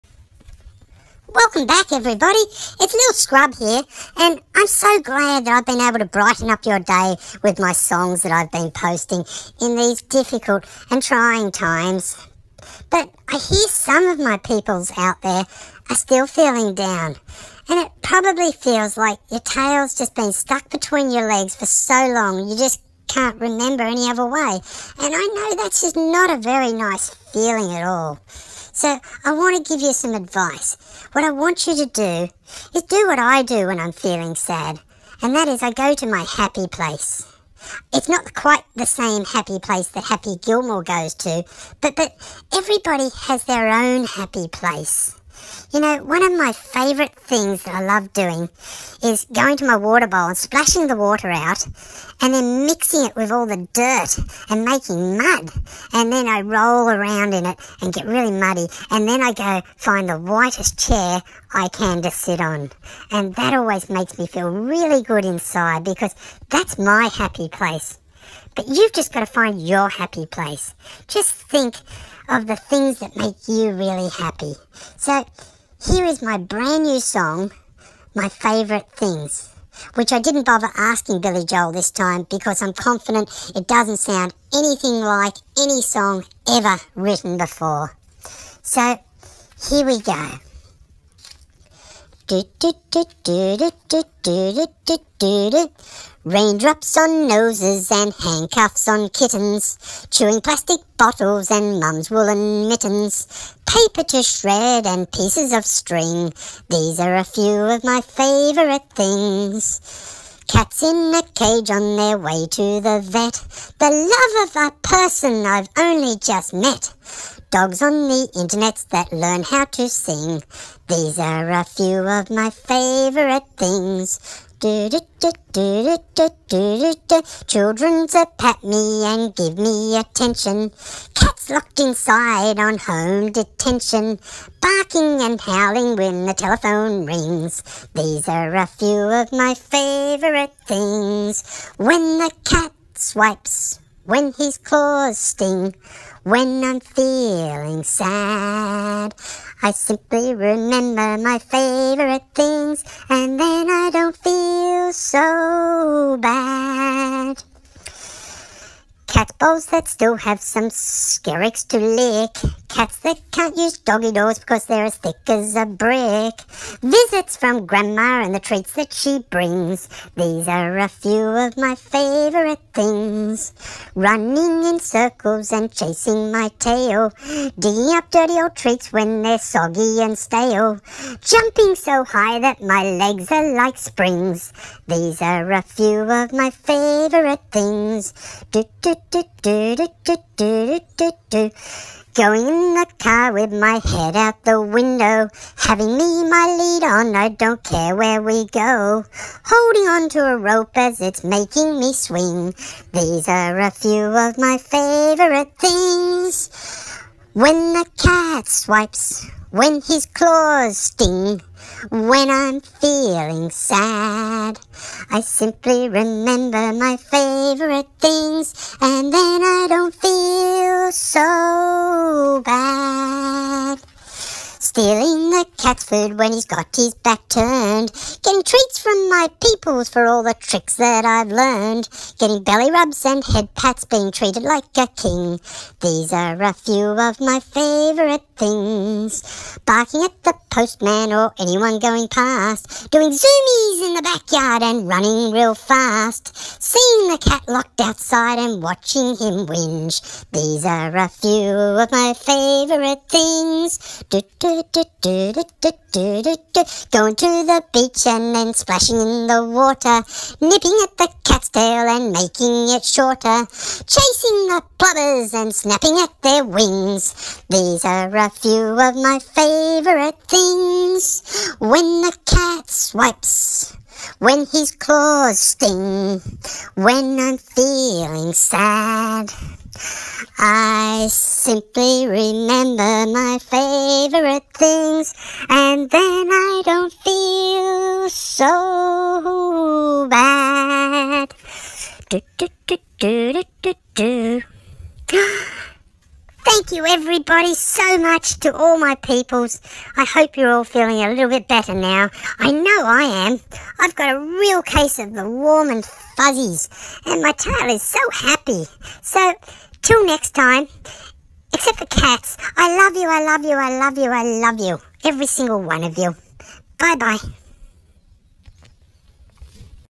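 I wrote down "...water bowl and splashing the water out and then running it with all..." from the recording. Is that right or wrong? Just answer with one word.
wrong.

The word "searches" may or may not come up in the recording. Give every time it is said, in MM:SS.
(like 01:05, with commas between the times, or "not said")
not said.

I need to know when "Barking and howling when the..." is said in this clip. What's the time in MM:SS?
02:14.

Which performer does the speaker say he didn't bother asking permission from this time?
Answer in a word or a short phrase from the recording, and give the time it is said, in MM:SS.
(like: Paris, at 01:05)
Billy Joel, at 01:21.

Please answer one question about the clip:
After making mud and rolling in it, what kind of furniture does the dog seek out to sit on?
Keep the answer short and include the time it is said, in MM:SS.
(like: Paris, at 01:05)
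the whitest chair, at 01:00.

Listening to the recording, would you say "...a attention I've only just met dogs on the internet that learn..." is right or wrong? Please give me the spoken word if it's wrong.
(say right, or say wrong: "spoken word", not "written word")
wrong: "person", not "attention".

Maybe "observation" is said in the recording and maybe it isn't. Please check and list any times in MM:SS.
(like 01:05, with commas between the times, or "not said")
not said.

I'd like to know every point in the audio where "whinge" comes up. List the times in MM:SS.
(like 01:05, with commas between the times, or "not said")
04:09.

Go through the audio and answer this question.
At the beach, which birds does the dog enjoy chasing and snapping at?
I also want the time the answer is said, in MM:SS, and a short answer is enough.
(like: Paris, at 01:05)
plovers, at 04:24.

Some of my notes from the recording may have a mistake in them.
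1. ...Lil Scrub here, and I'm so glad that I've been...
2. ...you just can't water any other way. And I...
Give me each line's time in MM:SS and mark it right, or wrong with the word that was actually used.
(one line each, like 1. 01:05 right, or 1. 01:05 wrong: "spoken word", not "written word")
1. 00:02 right
2. 00:22 wrong: "remember", not "water".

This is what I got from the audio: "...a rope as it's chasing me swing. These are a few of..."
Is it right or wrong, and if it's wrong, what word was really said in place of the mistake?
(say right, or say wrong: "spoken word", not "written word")
wrong: "making", not "chasing".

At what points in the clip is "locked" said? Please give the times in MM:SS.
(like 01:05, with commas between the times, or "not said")
02:11, 04:07.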